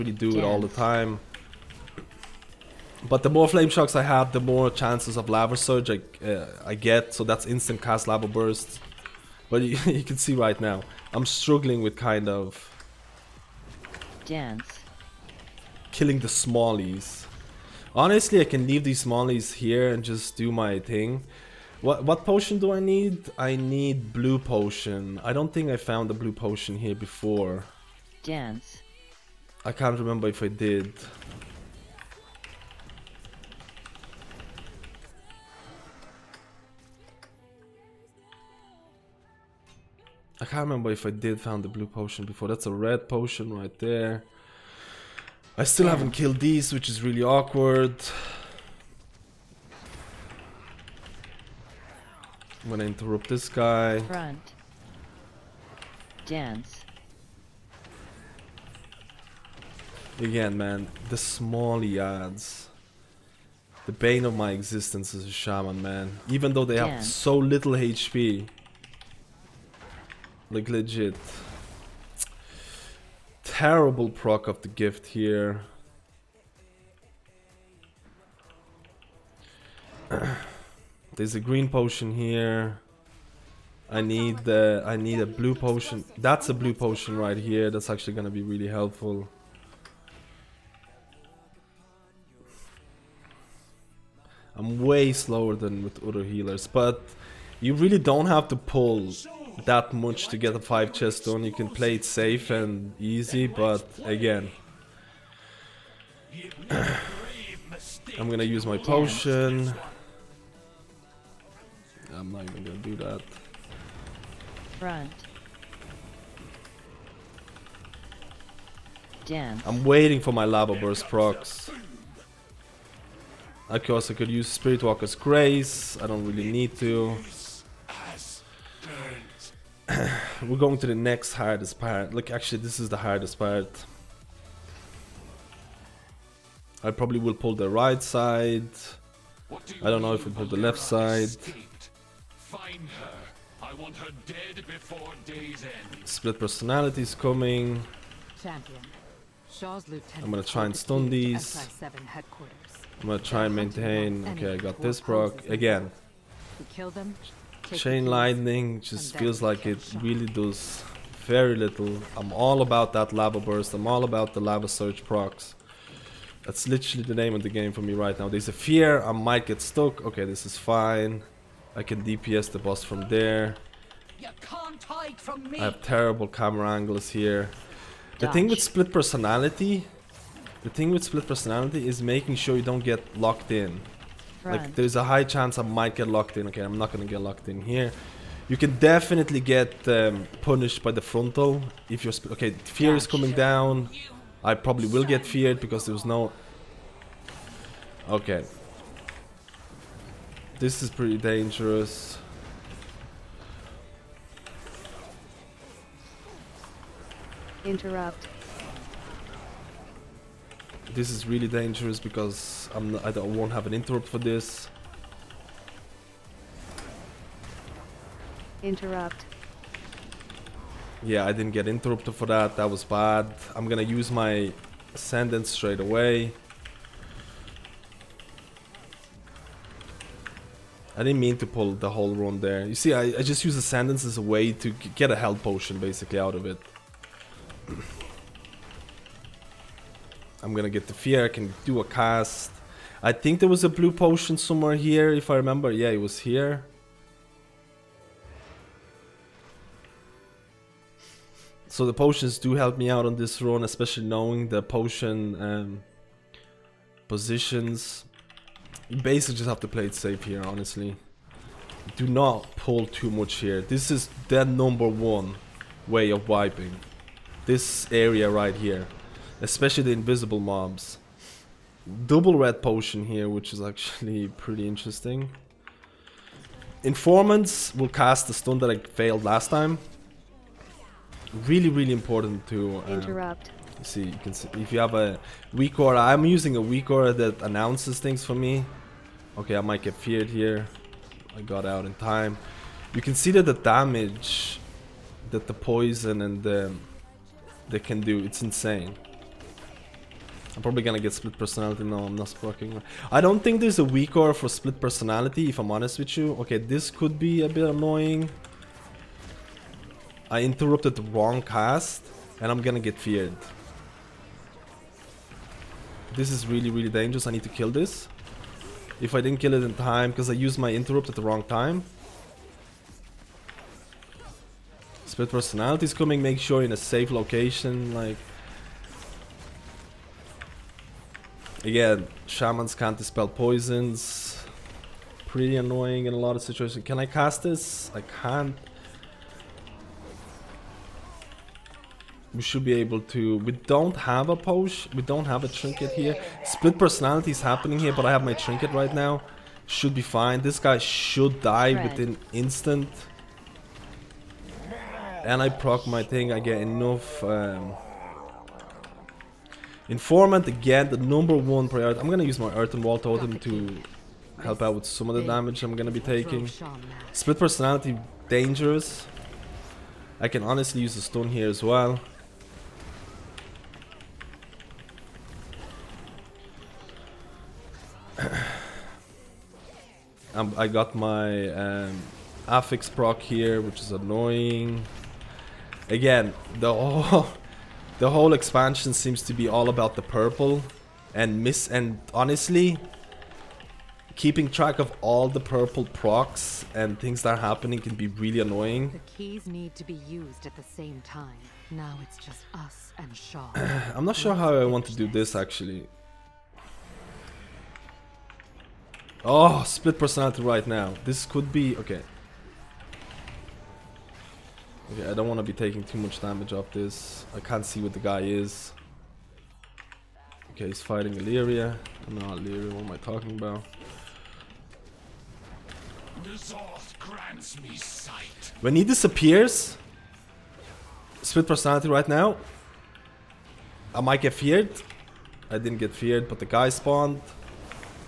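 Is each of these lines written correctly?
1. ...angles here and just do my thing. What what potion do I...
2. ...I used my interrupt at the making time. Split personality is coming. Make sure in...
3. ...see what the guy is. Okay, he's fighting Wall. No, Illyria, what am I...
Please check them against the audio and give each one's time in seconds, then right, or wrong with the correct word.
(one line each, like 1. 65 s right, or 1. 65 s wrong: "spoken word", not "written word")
1. 19 s wrong: "smallies", not "angles"
2. 320 s wrong: "wrong", not "making"
3. 417 s wrong: "Illyria", not "Wall".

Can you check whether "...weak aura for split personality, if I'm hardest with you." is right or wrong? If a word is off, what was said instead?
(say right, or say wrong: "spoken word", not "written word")
wrong: "honest", not "hardest".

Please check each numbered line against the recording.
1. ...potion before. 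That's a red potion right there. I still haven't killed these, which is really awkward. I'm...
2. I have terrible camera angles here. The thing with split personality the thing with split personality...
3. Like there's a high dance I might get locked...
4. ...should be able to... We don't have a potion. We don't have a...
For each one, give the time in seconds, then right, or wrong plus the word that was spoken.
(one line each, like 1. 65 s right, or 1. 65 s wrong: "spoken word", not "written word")
1. 41 s right
2. 174 s right
3. 184 s wrong: "chance", not "dance"
4. 342 s right.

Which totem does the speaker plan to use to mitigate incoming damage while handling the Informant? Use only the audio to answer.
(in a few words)
Earthen Wall Totem.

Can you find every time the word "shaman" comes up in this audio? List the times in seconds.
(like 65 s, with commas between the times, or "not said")
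65 s, 332 s.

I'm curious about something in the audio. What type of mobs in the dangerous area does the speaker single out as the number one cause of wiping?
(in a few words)
Invisible mobs.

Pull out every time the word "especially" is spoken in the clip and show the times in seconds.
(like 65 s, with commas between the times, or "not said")
253 s, 269 s.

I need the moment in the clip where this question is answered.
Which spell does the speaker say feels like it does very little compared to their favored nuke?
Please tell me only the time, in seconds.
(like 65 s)
157 s.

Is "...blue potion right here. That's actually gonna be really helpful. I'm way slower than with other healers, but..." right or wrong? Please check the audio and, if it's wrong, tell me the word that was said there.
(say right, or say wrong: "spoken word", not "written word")
right.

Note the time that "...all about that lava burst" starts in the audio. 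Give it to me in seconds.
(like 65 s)
162 s.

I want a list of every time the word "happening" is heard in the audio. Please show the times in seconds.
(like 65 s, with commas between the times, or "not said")
347 s, 397 s.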